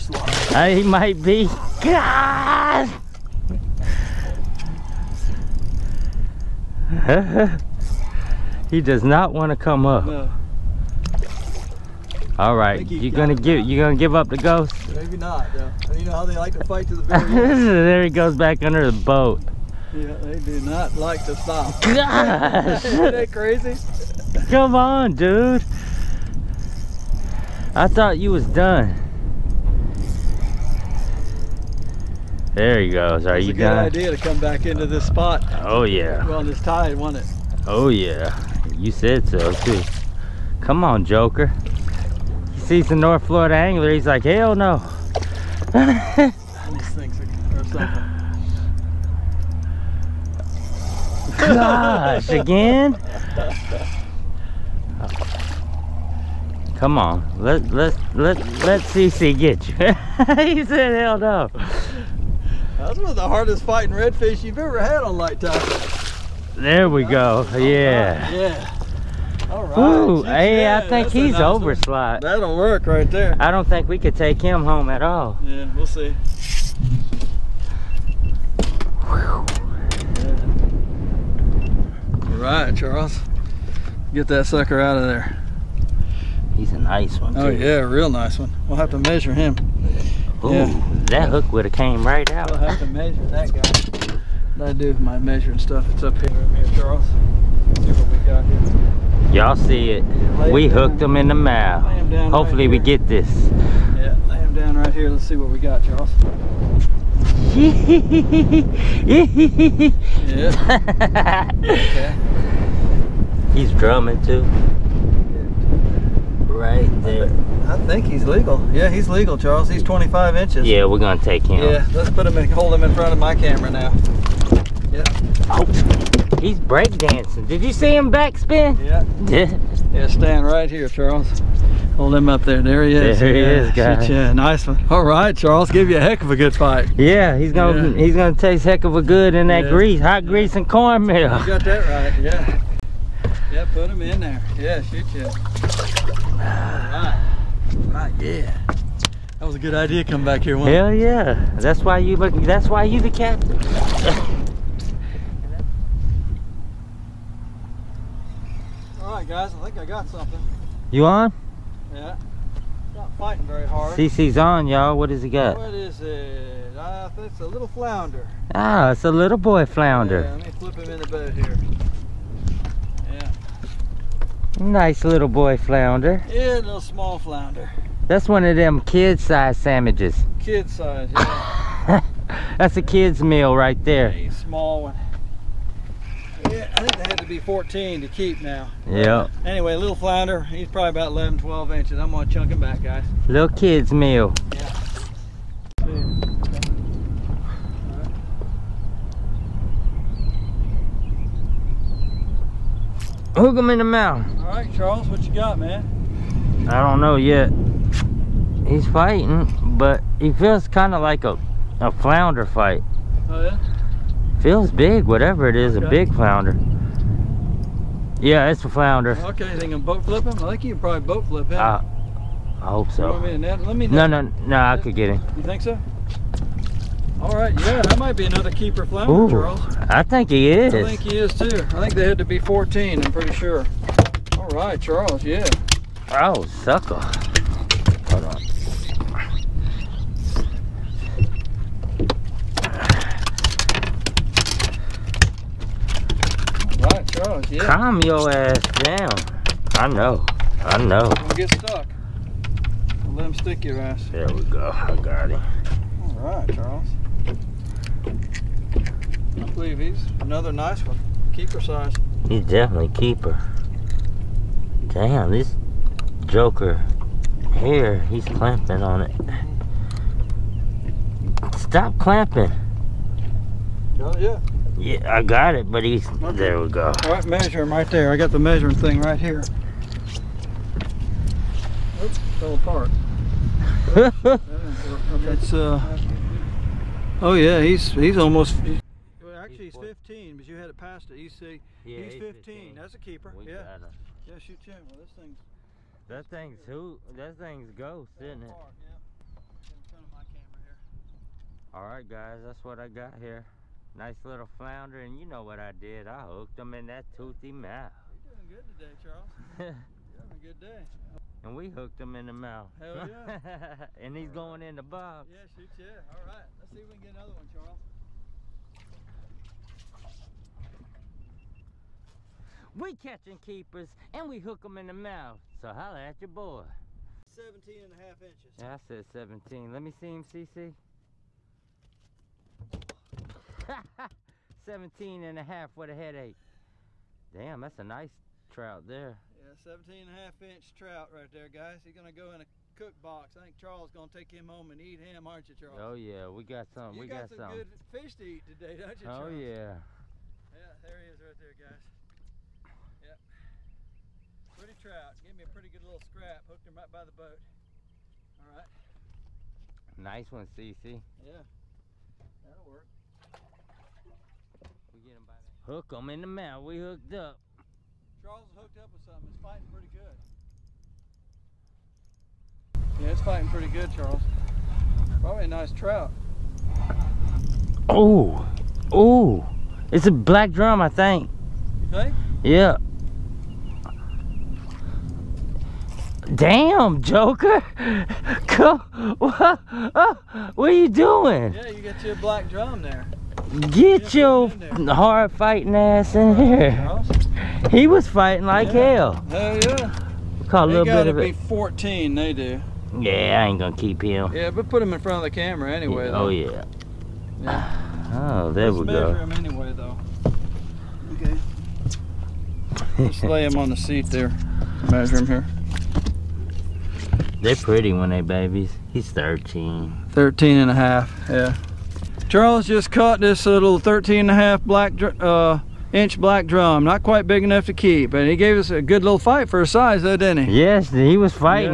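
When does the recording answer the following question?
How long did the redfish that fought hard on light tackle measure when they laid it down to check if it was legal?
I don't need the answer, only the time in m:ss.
1:59.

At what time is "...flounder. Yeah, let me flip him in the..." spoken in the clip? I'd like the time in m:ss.
2:49.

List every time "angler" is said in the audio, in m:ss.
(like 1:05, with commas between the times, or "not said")
0:43.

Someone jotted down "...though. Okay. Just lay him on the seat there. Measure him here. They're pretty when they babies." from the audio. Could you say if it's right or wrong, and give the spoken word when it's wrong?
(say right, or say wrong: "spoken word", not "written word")
right.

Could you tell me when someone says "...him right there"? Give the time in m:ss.
4:37.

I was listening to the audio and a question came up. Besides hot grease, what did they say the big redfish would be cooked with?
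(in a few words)
Cornmeal.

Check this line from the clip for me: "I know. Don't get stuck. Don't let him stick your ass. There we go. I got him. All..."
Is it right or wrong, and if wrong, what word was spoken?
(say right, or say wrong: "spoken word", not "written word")
right.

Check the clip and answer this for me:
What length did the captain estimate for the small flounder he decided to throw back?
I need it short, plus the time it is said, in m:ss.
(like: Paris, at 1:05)
11 to 12 inches, at 3:10.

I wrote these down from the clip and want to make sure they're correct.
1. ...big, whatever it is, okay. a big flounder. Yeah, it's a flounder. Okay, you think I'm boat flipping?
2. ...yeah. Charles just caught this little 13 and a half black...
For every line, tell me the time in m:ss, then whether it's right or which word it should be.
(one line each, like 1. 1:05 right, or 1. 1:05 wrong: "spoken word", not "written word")
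1. 3:34 right
2. 7:01 right.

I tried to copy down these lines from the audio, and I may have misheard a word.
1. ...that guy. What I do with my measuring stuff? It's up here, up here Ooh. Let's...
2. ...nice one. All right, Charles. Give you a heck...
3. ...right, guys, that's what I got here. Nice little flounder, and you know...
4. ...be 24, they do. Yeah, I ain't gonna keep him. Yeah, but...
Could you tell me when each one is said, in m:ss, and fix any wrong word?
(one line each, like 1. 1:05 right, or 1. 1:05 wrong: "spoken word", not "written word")
1. 1:33 wrong: "Charles", not "Ooh"
2. 2:14 right
3. 5:01 right
4. 6:41 wrong: "14", not "24".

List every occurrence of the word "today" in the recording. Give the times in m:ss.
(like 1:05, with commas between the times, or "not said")
5:08, 5:48.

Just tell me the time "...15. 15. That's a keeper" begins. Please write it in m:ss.
4:52.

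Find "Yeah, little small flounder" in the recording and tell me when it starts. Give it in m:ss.
2:56.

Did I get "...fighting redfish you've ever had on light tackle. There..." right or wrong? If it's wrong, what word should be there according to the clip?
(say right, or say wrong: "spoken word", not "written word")
right.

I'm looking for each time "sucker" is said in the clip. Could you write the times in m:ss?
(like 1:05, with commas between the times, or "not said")
1:24, 3:56.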